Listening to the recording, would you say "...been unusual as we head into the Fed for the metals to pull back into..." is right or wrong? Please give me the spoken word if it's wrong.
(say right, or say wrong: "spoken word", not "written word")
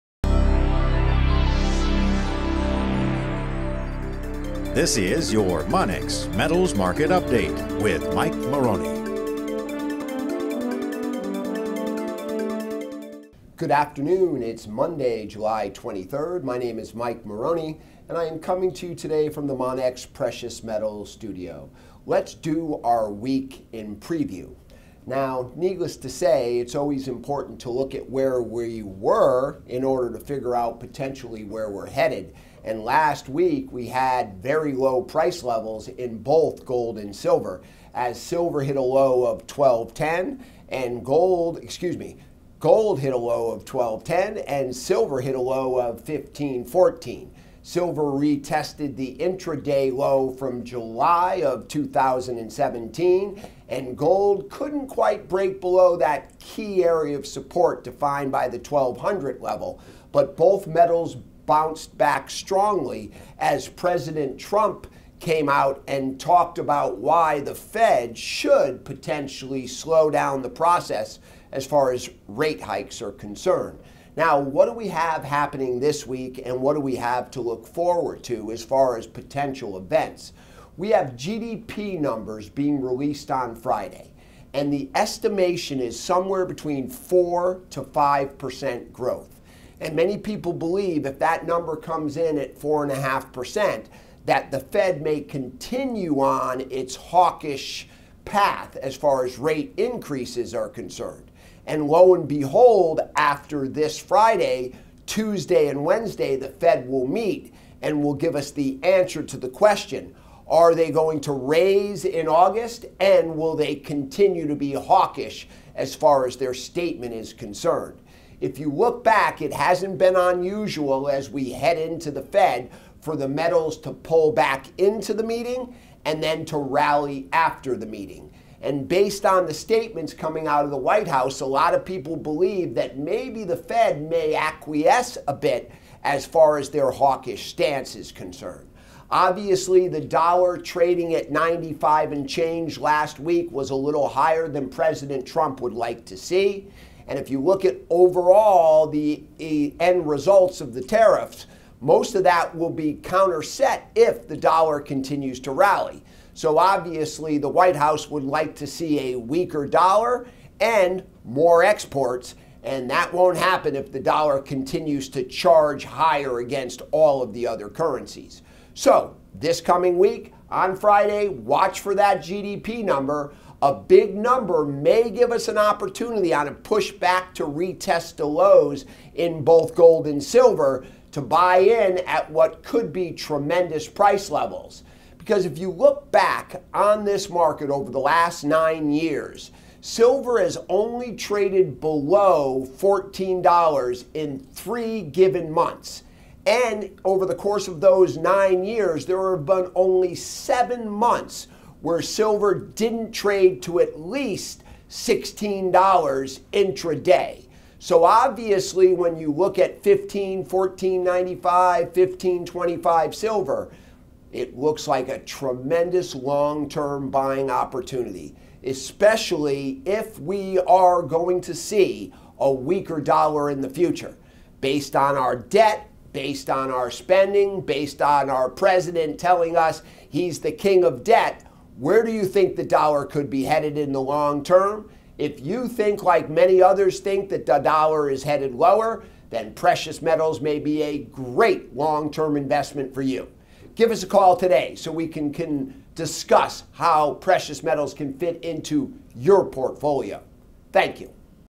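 right.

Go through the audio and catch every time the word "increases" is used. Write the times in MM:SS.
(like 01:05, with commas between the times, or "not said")
01:39.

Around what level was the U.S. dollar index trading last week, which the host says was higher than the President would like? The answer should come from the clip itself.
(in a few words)
95.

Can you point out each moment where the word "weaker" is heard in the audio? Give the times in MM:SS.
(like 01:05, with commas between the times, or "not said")
02:39, 03:42.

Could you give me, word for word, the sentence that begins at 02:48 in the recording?
So, this coming week, on Friday, watch for that GDP number.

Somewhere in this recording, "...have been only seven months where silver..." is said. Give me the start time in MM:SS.
03:19.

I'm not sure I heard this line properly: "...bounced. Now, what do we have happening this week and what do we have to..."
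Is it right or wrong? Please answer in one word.
wrong.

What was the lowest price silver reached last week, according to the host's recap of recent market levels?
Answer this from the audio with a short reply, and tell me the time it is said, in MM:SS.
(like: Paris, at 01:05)
15.14, at 00:46.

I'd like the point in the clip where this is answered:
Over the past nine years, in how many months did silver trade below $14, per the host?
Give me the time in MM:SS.
03:14.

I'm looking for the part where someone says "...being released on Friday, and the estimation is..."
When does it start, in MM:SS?
01:22.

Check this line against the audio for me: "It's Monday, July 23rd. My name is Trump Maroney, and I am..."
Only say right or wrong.
wrong.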